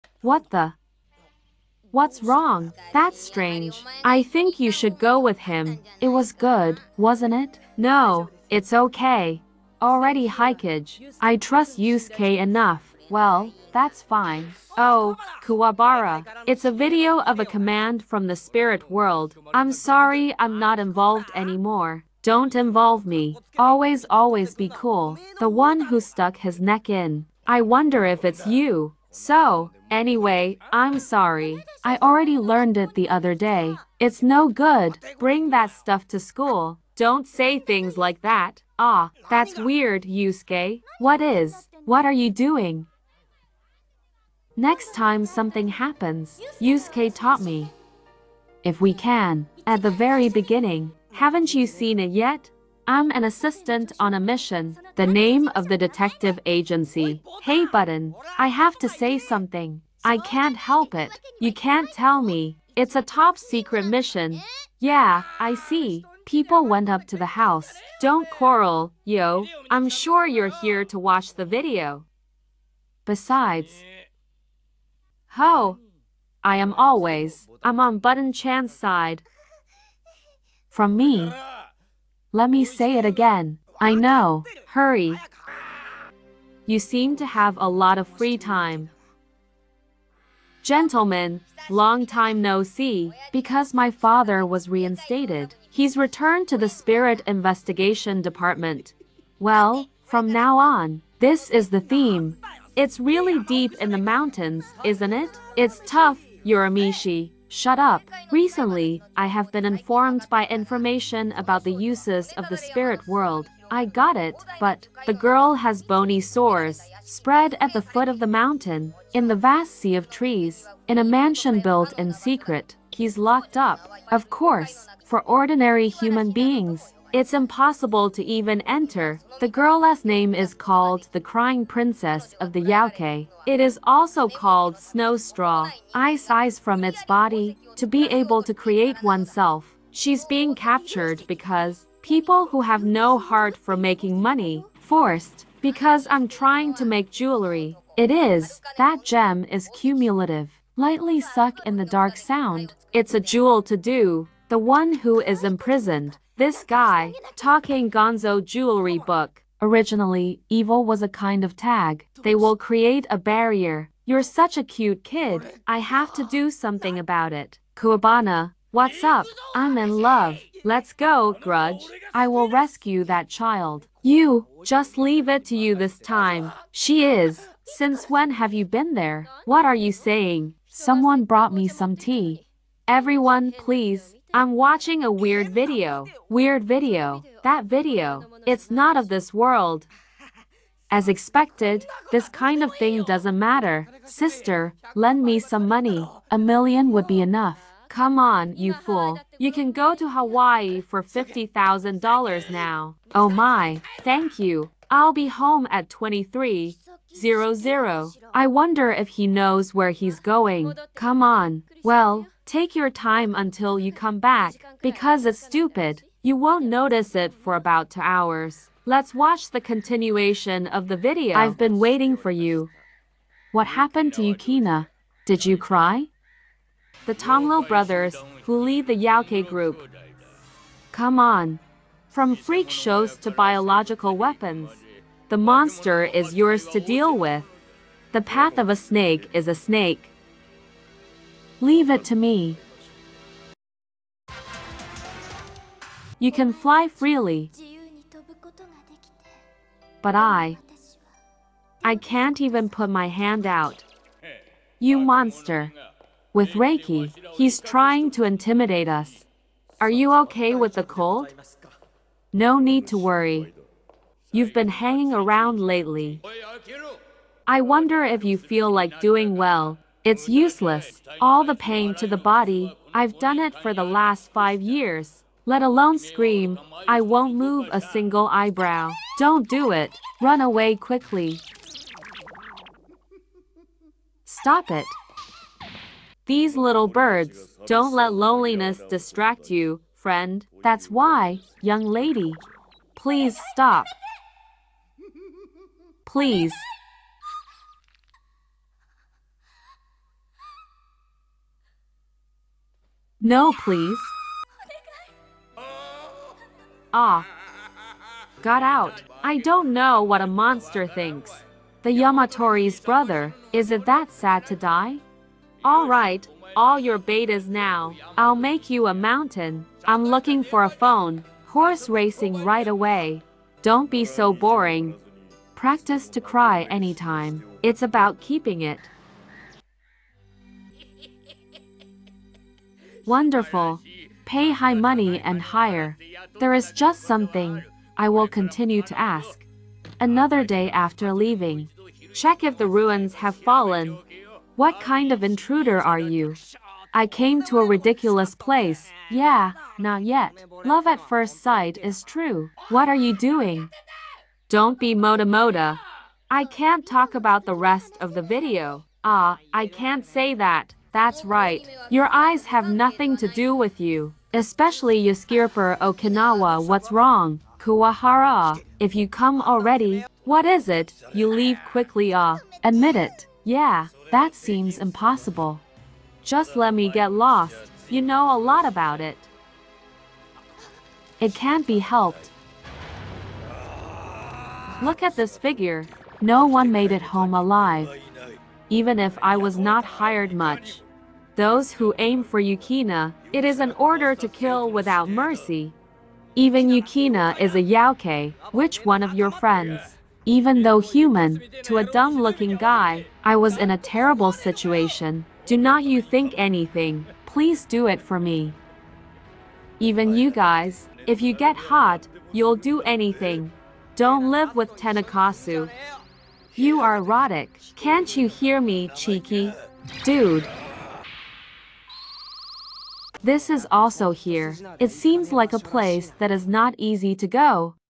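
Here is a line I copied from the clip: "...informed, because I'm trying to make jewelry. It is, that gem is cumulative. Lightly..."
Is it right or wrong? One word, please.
wrong.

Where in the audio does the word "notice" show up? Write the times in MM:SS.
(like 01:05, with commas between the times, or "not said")
03:36.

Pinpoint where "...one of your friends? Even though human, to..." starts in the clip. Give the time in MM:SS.
06:38.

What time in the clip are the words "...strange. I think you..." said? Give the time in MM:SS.
00:03.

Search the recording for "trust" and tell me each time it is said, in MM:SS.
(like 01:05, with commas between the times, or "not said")
00:11.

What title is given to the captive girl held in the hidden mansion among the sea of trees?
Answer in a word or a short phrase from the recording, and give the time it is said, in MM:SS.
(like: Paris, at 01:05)
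Crying Princess of the Yauke, at 02:11.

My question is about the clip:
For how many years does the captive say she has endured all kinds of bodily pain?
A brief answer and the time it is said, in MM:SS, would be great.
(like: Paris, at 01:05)
5, at 04:34.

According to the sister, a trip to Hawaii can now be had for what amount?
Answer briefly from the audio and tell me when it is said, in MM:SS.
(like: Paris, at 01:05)
$50,000, at 03:21.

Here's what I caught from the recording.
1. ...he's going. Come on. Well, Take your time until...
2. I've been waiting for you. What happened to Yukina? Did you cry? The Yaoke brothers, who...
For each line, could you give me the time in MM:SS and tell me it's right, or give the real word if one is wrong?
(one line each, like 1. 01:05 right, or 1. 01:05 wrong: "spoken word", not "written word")
1. 03:29 right
2. 03:41 wrong: "Toguro", not "Yaoke".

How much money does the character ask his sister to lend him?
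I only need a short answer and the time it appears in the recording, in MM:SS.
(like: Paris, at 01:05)
1,000,000, at 03:16.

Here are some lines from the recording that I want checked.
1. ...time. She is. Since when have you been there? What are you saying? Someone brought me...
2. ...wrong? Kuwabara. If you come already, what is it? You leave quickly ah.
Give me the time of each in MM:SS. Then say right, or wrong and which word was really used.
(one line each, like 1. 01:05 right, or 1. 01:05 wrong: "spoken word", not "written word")
1. 02:55 right
2. 06:06 right.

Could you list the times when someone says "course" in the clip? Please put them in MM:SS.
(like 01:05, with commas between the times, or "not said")
02:04.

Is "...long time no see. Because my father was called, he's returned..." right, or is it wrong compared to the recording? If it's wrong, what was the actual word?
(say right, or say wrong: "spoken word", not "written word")
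wrong: "reinstated", not "called".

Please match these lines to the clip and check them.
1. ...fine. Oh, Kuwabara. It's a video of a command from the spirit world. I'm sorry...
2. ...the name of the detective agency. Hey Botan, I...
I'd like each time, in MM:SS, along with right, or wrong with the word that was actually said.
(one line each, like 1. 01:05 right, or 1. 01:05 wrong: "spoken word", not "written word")
1. 00:14 right
2. 00:54 right.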